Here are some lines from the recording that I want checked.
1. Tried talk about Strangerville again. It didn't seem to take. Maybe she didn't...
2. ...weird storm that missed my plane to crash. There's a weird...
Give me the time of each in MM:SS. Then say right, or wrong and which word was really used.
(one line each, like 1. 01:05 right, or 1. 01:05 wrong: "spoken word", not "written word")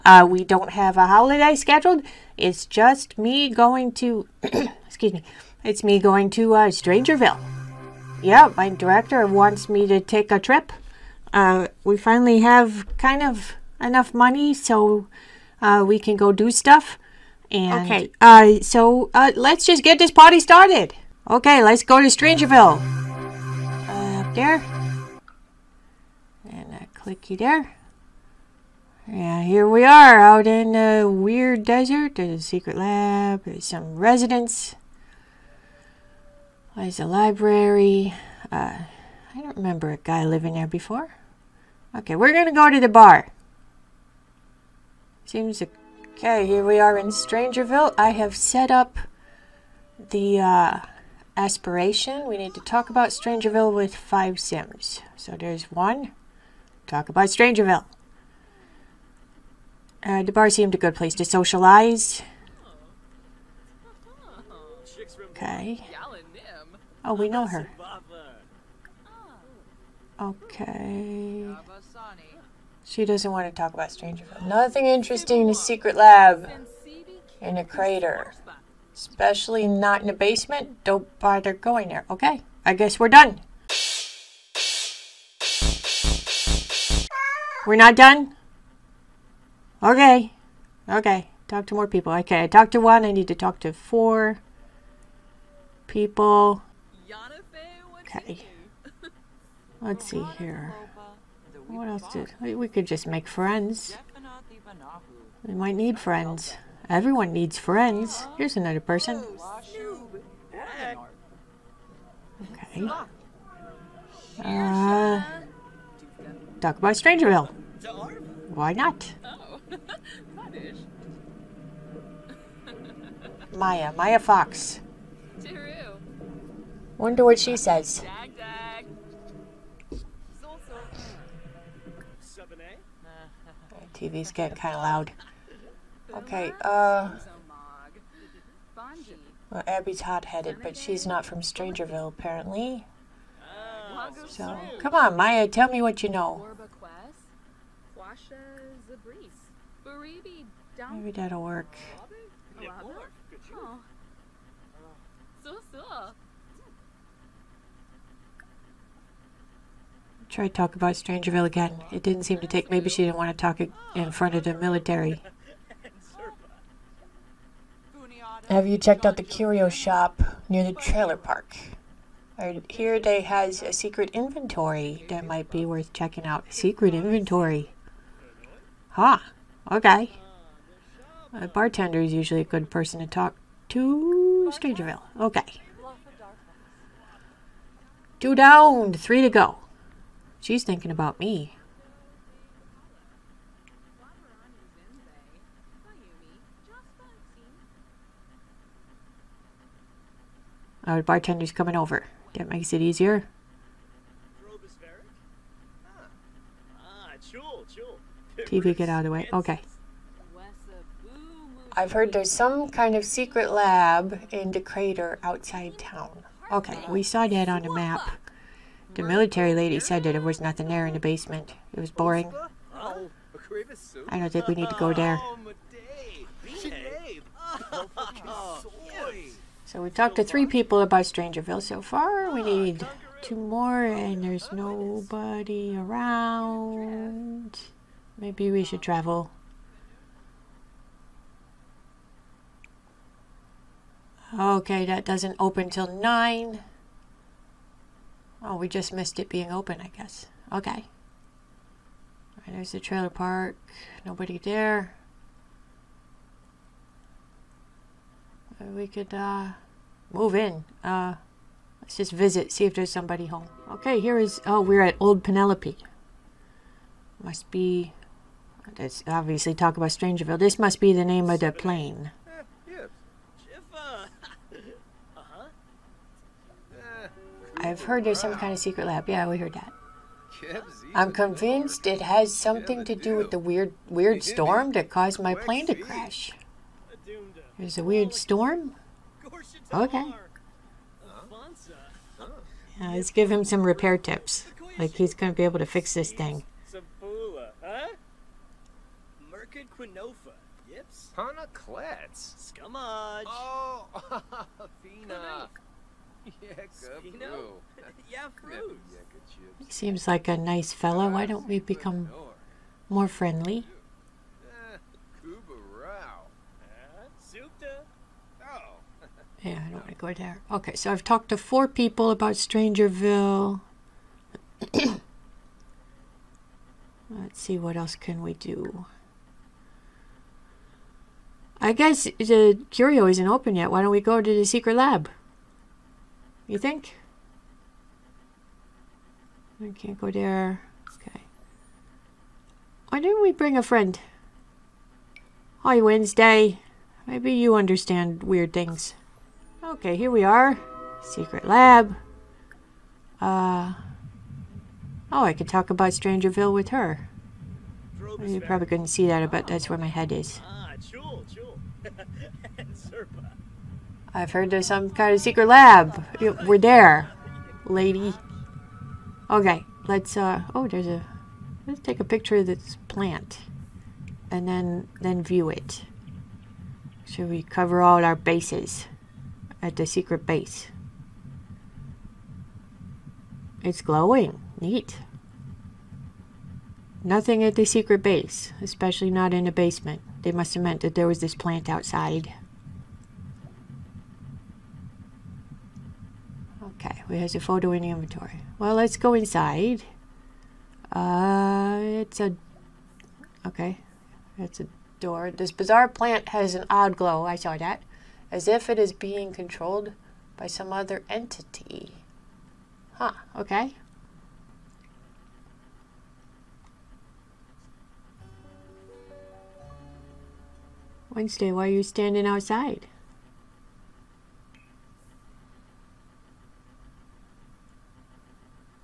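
1. 02:40 right
2. 04:43 wrong: "caused", not "missed".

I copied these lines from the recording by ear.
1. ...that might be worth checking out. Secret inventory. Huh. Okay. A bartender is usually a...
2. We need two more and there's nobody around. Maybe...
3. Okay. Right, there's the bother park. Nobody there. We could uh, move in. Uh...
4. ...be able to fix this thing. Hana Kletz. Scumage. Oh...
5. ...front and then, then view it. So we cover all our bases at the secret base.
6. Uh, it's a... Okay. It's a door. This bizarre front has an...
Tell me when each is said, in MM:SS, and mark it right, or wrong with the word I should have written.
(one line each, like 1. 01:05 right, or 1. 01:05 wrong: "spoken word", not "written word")
1. 02:55 right
2. 03:52 right
3. 04:10 wrong: "trailer", not "bother"
4. 04:55 right
5. 06:12 wrong: "plant", not "front"
6. 06:40 wrong: "plant", not "front".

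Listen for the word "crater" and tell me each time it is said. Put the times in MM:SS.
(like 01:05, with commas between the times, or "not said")
01:17, 03:34.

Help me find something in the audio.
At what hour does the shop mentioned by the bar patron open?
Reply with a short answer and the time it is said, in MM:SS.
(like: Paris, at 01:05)
9, at 04:05.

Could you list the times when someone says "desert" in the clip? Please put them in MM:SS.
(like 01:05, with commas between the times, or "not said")
00:31.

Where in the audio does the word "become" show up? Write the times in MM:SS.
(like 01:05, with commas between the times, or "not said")
05:11.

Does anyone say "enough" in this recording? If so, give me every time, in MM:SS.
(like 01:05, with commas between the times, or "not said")
00:13.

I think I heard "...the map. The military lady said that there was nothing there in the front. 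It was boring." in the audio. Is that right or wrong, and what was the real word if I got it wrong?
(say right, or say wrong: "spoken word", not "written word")
wrong: "basement", not "front".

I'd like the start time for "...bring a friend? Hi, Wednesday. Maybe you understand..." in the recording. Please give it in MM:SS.
05:43.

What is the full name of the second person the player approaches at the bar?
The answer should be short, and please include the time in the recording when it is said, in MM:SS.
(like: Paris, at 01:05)
Maya Fox, at 02:03.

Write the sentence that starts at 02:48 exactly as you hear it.
Have you checked out the curio shop near the trailer park?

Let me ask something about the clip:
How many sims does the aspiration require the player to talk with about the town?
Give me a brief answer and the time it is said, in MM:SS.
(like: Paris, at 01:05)
5, at 00:53.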